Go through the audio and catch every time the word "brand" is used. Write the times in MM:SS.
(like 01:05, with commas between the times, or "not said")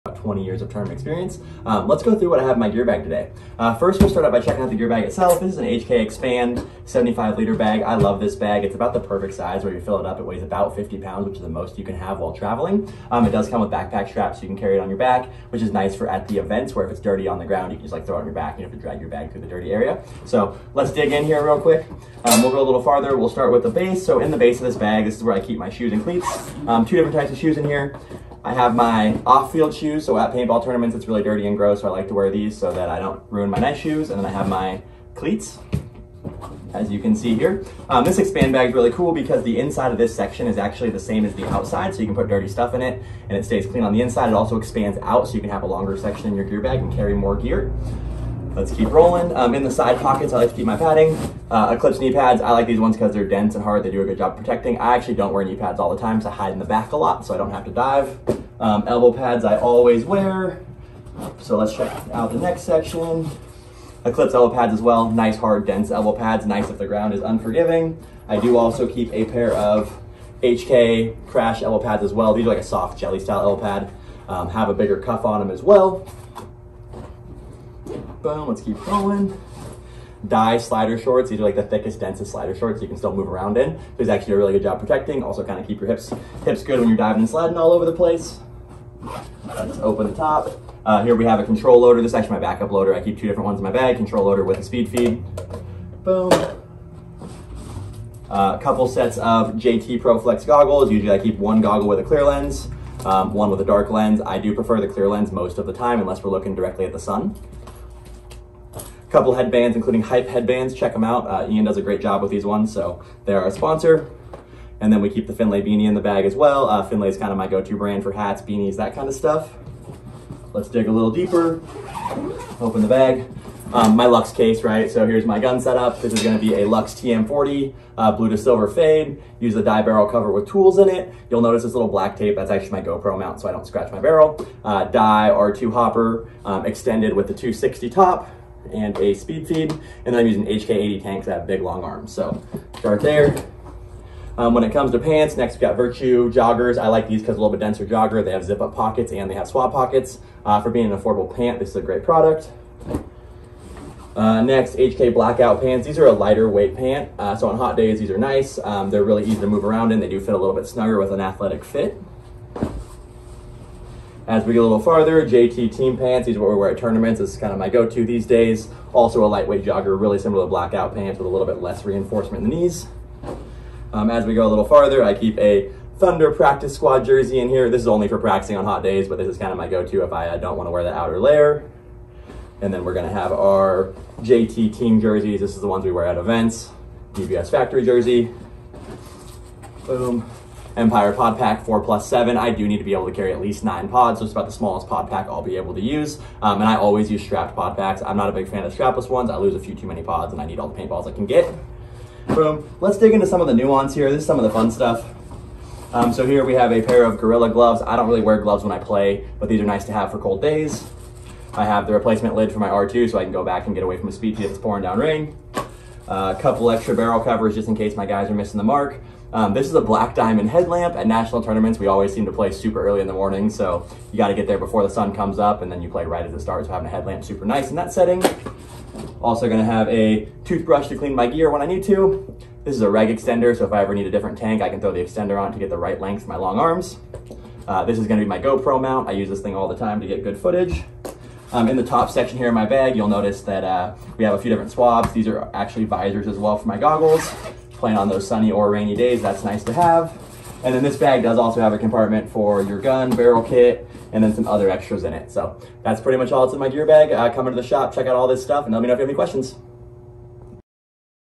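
01:57.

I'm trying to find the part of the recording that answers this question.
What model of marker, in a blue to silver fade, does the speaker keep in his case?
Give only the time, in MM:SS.
02:06.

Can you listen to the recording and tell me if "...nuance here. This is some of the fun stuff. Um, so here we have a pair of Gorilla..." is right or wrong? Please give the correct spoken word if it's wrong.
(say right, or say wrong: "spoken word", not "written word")
right.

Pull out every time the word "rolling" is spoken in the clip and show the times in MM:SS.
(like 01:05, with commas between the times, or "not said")
00:48, 01:18.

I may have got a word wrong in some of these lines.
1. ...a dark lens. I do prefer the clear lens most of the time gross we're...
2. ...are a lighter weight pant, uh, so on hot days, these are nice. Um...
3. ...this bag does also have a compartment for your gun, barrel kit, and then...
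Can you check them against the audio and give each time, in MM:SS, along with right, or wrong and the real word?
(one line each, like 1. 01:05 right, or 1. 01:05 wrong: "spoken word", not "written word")
1. 01:43 wrong: "unless", not "gross"
2. 02:35 right
3. 04:10 right.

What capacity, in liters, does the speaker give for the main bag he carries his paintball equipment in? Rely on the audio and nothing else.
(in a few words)
75 liters.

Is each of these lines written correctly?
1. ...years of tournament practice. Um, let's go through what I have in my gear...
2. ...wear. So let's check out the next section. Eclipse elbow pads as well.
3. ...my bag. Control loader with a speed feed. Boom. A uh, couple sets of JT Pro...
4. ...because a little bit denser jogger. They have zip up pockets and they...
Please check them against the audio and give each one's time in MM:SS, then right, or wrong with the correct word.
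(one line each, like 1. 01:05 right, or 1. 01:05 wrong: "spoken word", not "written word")
1. 00:00 wrong: "experience", not "practice"
2. 01:00 right
3. 01:33 right
4. 02:27 right.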